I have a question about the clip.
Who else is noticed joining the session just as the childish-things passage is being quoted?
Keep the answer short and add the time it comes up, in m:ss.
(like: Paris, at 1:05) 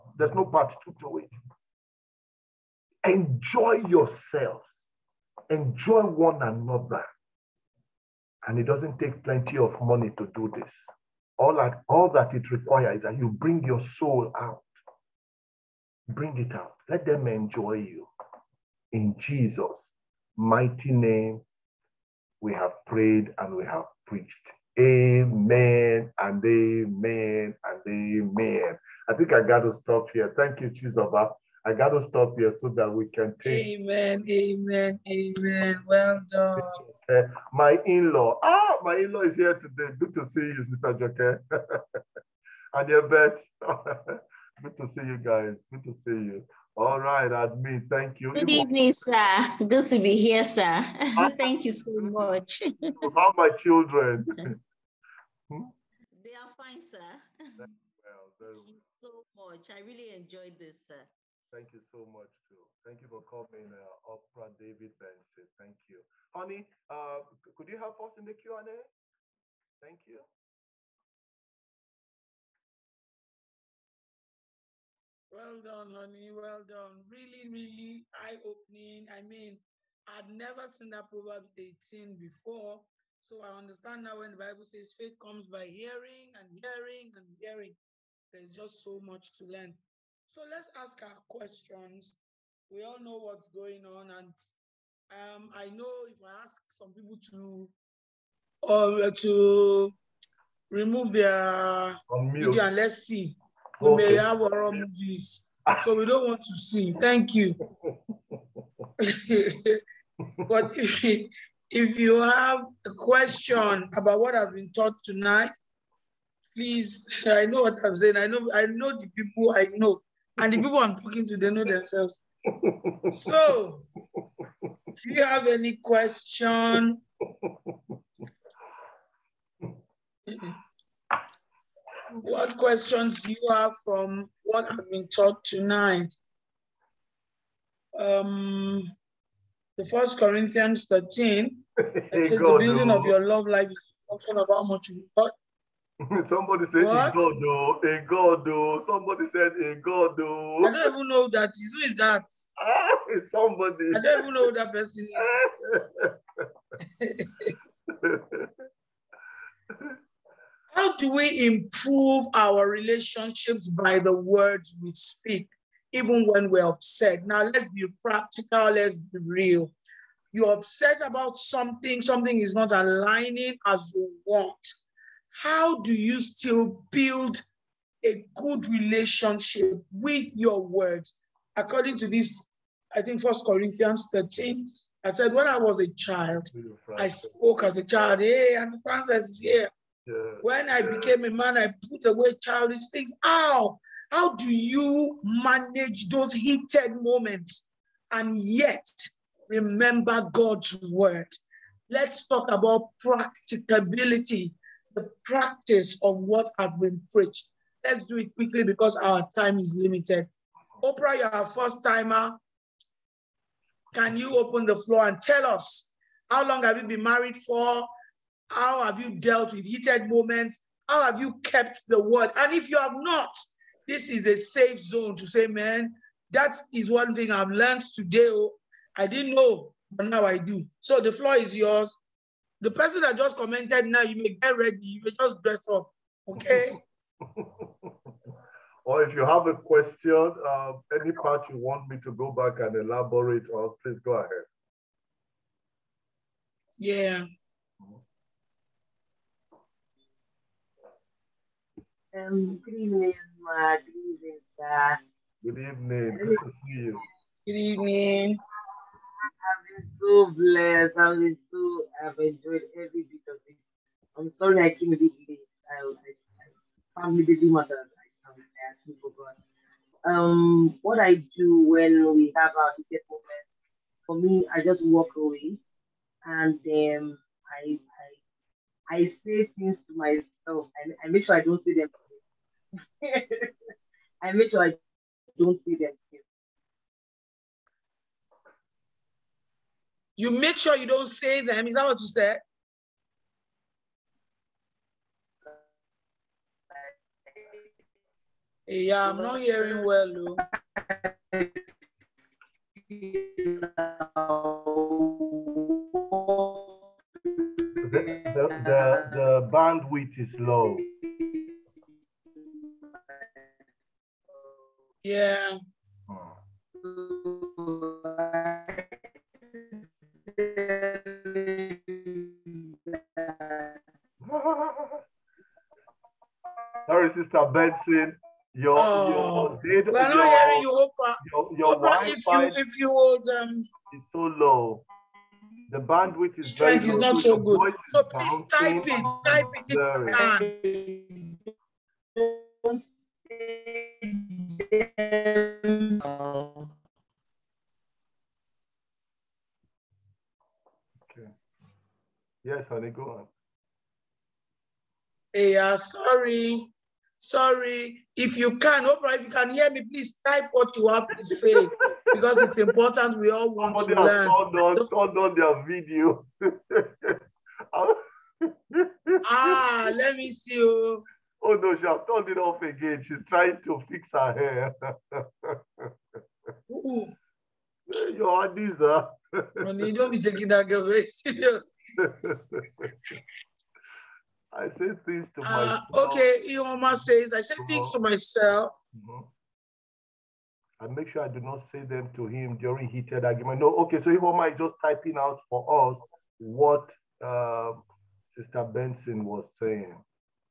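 Francis, at 3:08.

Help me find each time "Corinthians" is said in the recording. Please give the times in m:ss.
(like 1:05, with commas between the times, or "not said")
2:20, 3:03.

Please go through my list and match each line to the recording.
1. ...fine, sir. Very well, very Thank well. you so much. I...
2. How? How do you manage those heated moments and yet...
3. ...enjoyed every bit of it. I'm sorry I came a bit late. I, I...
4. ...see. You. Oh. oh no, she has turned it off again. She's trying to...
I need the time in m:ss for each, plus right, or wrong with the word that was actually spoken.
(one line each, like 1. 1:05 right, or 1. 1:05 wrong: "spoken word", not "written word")
1. 0:56 right
2. 3:13 right
3. 4:22 right
4. 6:10 right.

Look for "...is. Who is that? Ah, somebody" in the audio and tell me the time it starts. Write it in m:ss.
2:31.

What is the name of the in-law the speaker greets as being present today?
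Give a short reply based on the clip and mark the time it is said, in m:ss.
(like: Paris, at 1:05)
Sister Joke, at 0:40.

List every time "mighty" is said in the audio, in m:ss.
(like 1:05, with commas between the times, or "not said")
0:20.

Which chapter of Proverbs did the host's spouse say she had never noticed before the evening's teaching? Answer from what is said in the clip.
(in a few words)
Proverbs 18.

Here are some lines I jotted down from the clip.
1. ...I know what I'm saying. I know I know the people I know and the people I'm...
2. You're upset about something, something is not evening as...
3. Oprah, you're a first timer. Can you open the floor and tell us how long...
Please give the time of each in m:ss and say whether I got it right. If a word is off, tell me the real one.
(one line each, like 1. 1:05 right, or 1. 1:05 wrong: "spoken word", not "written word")
1. 1:57 right
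2. 2:50 wrong: "aligning", not "evening"
3. 3:30 right.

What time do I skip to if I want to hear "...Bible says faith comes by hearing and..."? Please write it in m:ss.
1:24.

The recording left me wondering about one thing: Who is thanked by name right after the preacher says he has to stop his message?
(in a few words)
Chizoba.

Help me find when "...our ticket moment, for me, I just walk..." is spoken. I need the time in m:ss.
4:32.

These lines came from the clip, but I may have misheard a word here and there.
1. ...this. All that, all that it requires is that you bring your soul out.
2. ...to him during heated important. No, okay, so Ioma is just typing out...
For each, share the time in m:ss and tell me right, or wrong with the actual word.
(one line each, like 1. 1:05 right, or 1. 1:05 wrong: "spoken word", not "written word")
1. 0:10 right
2. 6:32 wrong: "argument", not "important".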